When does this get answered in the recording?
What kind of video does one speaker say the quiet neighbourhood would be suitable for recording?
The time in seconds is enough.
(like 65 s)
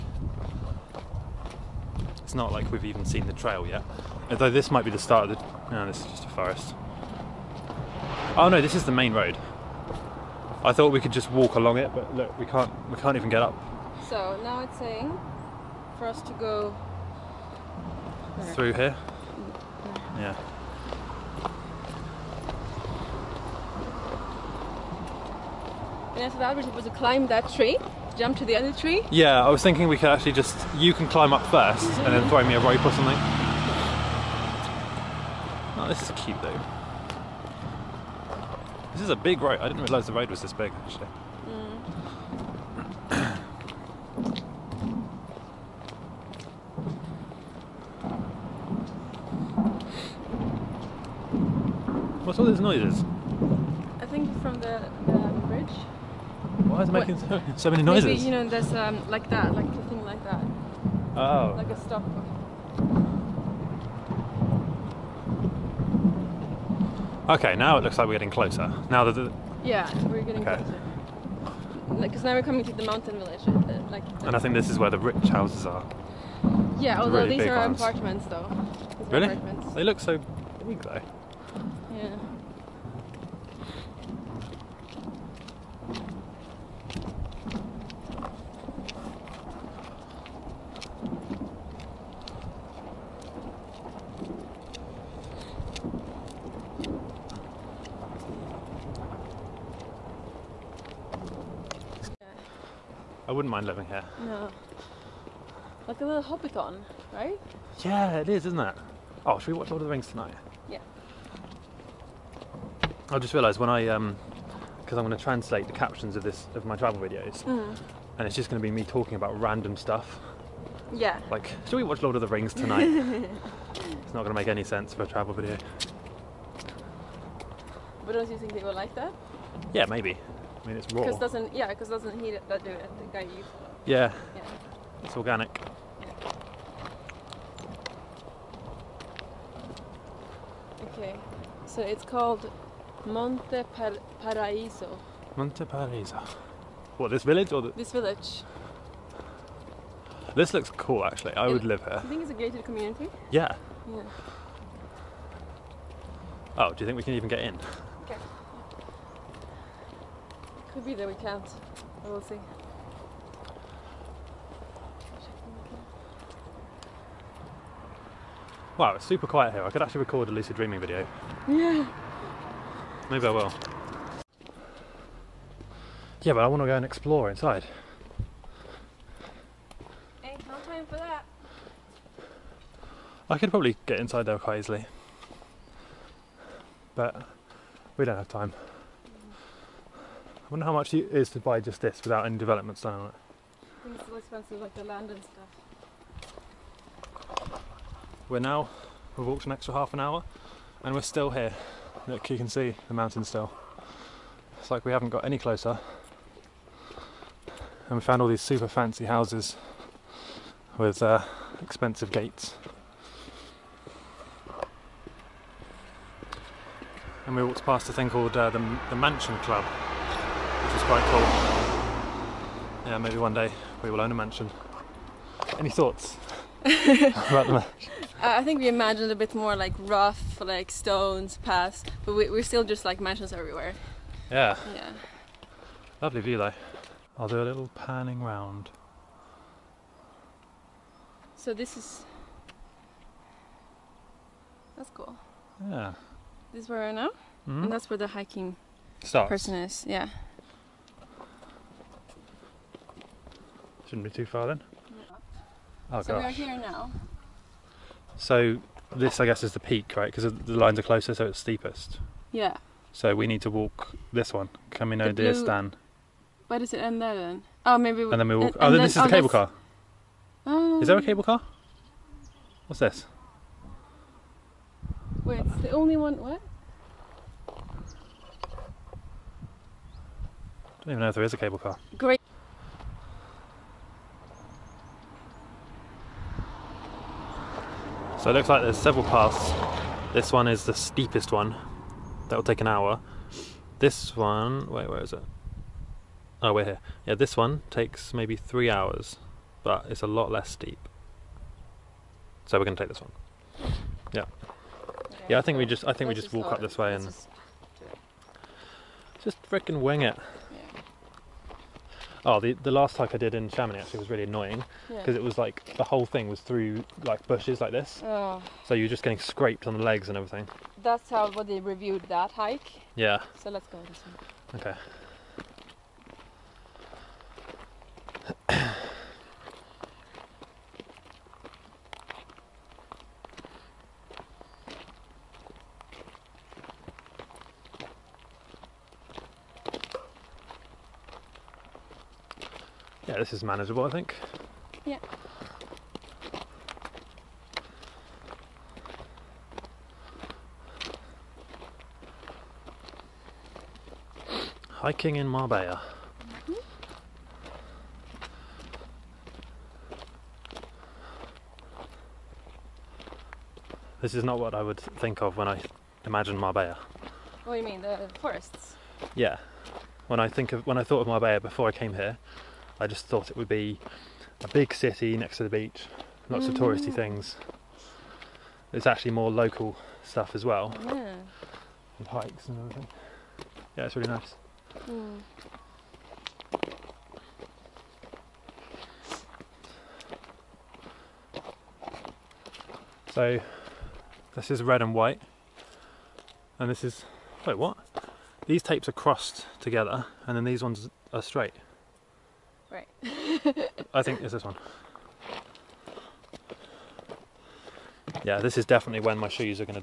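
170 s.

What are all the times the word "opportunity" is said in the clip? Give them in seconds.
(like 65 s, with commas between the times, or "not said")
not said.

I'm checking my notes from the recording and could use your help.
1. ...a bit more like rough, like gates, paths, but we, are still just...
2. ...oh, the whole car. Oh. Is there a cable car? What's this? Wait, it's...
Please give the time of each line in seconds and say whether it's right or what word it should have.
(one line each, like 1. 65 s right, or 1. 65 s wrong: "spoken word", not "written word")
1. 229 s wrong: "stones", not "gates"
2. 268 s wrong: "cable", not "whole".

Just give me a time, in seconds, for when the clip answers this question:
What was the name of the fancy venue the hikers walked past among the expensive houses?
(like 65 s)
218 s.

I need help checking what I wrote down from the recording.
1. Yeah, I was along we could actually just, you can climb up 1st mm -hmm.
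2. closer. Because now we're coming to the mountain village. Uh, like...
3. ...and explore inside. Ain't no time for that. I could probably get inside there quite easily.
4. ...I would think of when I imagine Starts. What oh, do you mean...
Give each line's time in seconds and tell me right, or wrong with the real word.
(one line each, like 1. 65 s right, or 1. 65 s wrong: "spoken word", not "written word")
1. 29 s wrong: "thinking", not "along"
2. 70 s right
3. 176 s right
4. 364 s wrong: "Marbella", not "Starts".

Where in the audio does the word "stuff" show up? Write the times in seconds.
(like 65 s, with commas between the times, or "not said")
119 s, 195 s, 380 s.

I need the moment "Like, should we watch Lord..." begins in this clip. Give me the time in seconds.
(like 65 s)
121 s.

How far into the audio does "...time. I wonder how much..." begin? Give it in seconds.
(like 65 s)
188 s.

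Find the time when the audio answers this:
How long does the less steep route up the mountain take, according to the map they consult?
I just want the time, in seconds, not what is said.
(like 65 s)
298 s.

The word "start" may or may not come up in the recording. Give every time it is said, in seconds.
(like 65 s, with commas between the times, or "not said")
4 s, 249 s.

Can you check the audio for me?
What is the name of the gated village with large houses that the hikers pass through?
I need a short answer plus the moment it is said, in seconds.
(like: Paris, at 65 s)
Monte Paraiso, at 145 s.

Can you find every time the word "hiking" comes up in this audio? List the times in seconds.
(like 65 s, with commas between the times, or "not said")
248 s, 354 s.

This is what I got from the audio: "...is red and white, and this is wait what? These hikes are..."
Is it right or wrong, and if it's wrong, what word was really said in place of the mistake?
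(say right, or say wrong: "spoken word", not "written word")
wrong: "tapes", not "hikes".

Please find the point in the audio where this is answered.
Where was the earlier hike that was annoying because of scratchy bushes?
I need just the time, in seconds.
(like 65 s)
313 s.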